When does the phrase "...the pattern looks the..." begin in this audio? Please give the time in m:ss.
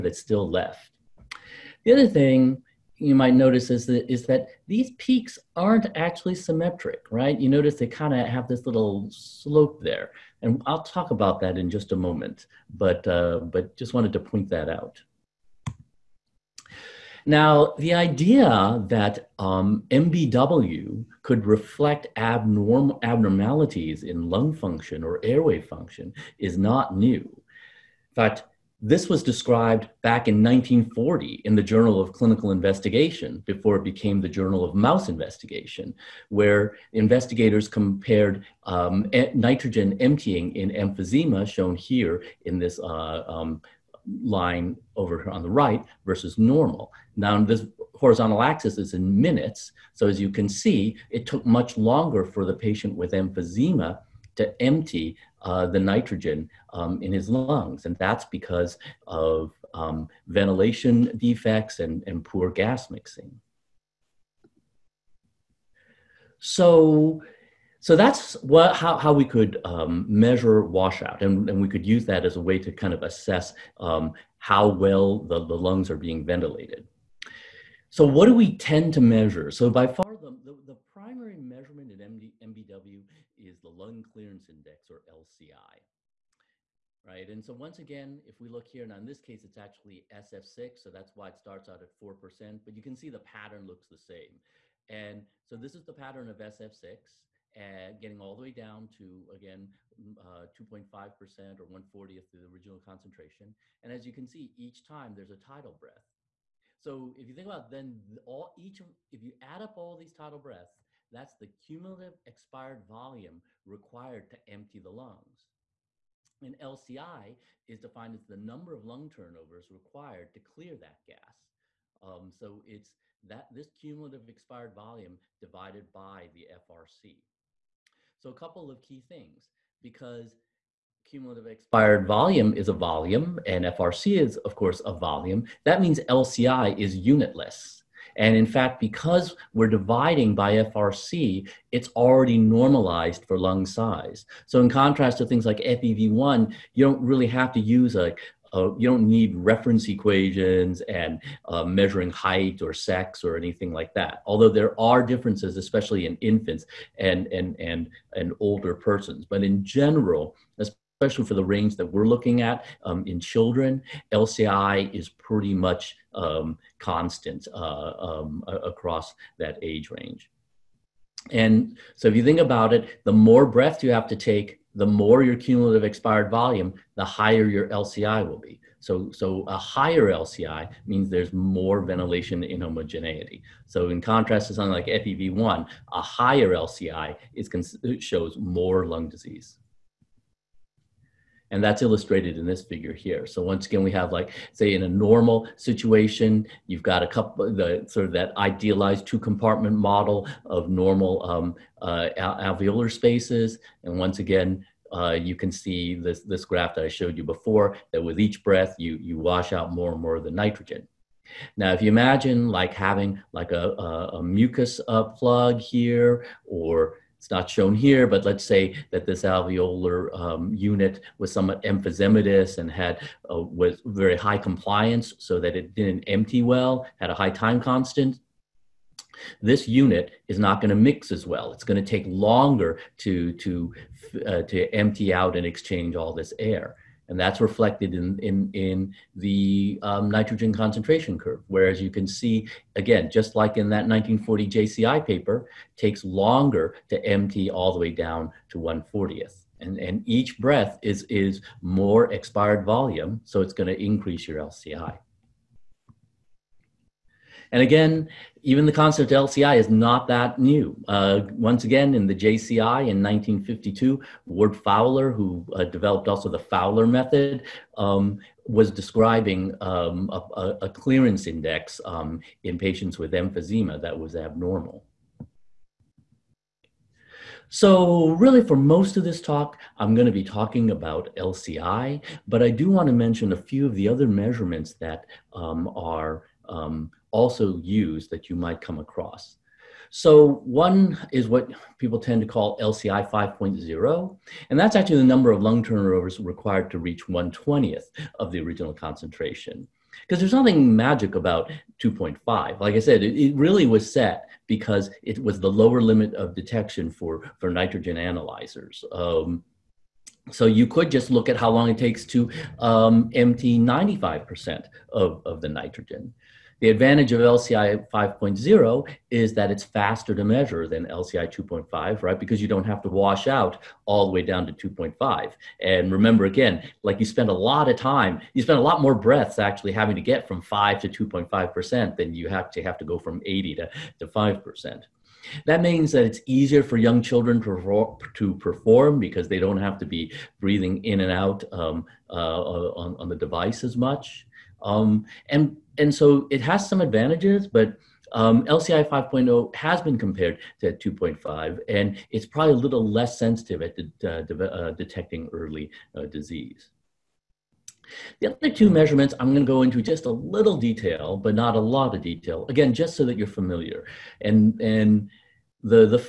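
1:33.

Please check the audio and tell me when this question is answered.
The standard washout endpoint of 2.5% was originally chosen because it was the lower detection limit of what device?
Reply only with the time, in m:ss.
5:07.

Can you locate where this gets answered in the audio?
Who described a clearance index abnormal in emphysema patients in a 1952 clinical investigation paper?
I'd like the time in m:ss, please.
4:24.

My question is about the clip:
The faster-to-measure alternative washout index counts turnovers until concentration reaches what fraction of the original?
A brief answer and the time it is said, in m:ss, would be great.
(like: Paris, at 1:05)
1/20, at 4:57.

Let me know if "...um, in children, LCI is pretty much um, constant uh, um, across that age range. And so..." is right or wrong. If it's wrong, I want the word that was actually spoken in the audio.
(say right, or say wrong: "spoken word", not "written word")
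right.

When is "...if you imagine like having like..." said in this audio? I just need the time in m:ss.
3:31.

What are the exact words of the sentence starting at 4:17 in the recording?
And again, even the concept of LCI is not that new.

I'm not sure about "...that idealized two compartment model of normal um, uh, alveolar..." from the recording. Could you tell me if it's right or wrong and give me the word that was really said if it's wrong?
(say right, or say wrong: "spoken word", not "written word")
right.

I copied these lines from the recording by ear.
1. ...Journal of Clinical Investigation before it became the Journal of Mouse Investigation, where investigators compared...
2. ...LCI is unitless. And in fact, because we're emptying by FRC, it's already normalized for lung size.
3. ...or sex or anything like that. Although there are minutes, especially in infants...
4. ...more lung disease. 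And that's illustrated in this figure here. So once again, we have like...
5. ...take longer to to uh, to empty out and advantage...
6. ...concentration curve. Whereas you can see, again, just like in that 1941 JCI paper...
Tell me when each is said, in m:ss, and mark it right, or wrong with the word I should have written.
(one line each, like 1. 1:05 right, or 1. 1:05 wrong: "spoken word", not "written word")
1. 0:31 right
2. 2:16 wrong: "dividing", not "emptying"
3. 2:32 wrong: "differences", not "minutes"
4. 3:08 right
5. 3:51 wrong: "exchange", not "advantage"
6. 4:00 wrong: "1940", not "1941".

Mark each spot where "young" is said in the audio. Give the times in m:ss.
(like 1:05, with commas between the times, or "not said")
5:36.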